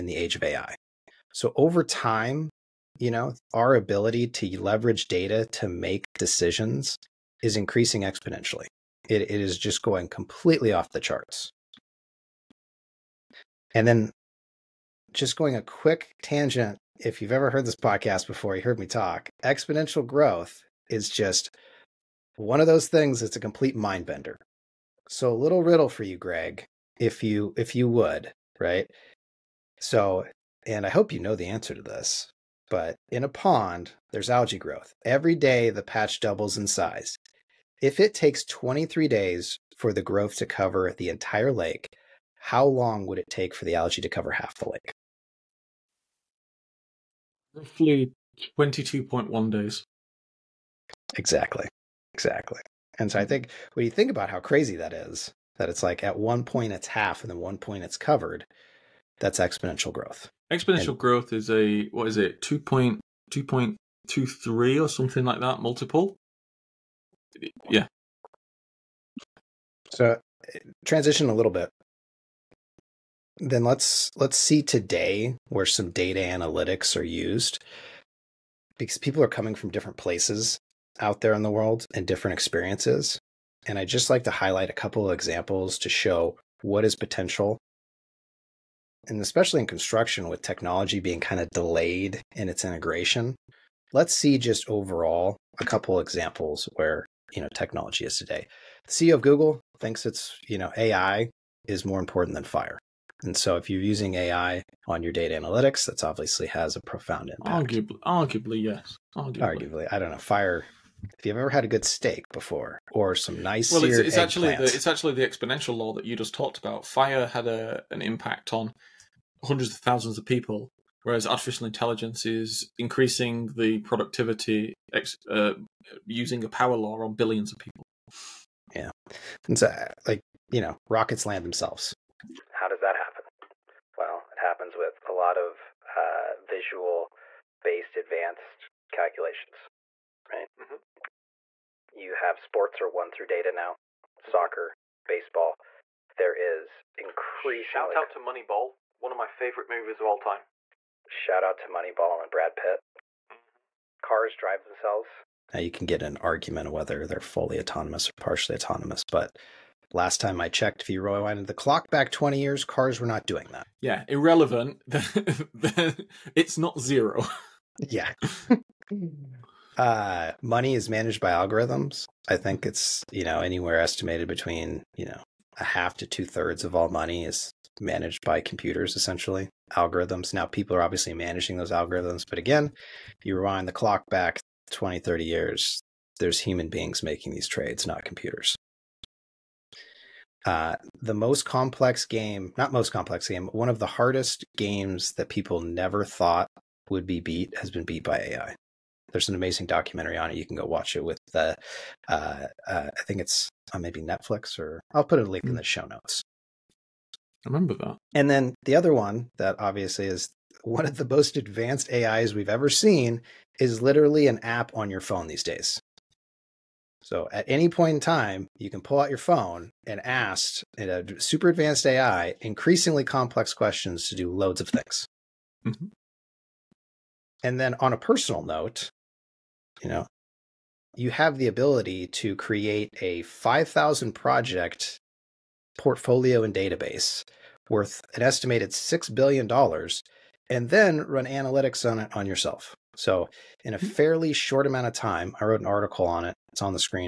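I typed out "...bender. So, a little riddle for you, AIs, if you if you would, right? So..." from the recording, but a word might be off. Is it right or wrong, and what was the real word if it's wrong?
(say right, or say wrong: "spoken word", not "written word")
wrong: "Greg", not "AIs".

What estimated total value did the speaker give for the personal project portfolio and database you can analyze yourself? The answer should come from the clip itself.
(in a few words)
$6 billion.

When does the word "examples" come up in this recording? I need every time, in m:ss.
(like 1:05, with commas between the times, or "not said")
1:25, 1:35.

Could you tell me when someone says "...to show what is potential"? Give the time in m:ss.
1:25.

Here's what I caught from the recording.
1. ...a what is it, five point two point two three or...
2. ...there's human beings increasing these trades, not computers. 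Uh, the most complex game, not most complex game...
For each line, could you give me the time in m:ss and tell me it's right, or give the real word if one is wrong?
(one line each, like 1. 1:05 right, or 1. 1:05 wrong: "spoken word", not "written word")
1. 1:01 wrong: "two", not "five"
2. 3:06 wrong: "making", not "increasing".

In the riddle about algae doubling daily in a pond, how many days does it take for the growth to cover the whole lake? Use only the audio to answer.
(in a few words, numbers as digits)
23.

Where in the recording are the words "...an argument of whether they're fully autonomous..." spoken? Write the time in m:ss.
2:36.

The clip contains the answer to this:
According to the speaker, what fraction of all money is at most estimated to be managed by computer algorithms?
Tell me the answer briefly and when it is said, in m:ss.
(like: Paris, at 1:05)
two thirds, at 2:56.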